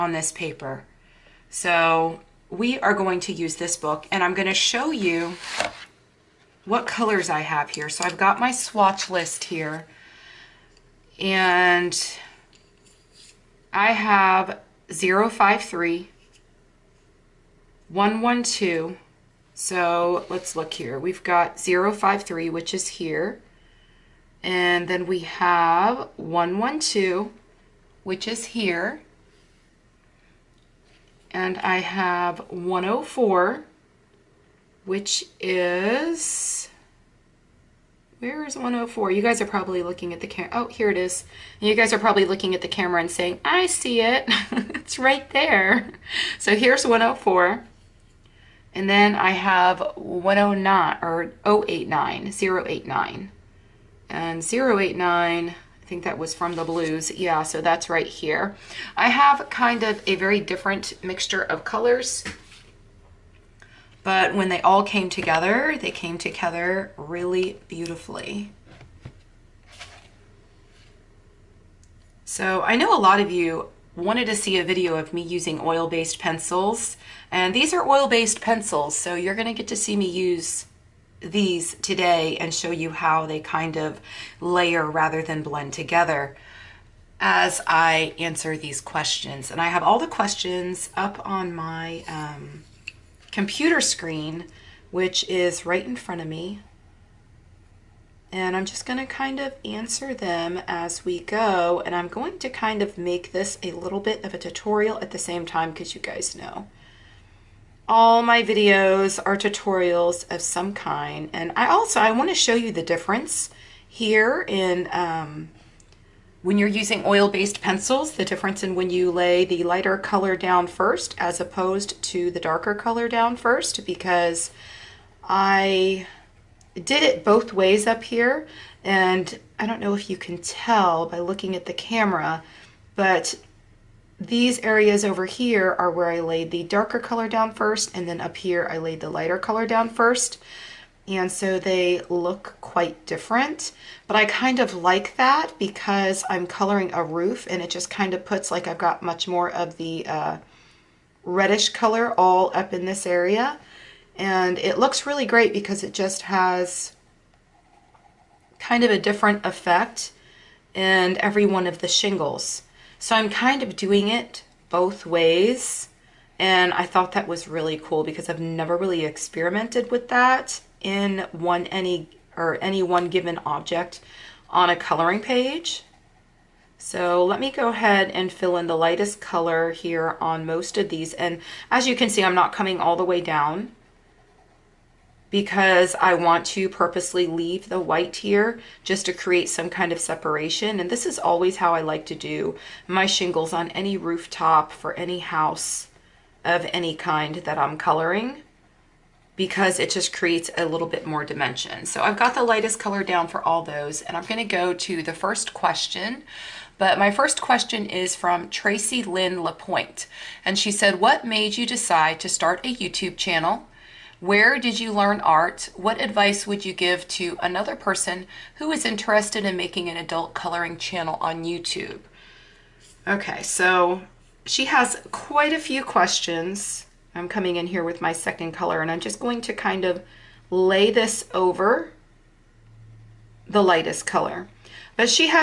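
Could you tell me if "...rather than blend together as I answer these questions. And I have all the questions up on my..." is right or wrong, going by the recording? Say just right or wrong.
right.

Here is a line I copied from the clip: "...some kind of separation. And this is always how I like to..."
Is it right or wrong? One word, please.
right.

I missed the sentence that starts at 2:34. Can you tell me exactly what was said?
And it looks really great because it just has kind of a different effect in every one of the shingles.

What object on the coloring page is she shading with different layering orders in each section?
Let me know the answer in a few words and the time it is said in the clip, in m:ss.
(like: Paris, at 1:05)
A roof, at 2:26.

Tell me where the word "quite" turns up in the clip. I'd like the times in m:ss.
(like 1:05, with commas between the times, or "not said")
2:22, 3:45.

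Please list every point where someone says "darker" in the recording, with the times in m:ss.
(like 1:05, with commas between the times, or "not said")
2:02, 2:16.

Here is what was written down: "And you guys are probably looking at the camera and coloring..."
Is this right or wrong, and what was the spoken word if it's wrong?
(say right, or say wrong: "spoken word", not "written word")
wrong: "saying", not "coloring".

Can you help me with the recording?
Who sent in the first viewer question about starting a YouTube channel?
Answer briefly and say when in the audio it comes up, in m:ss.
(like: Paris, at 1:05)
Tracy Lynn LaPointe, at 3:28.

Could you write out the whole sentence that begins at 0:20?
We've got 053, which is here.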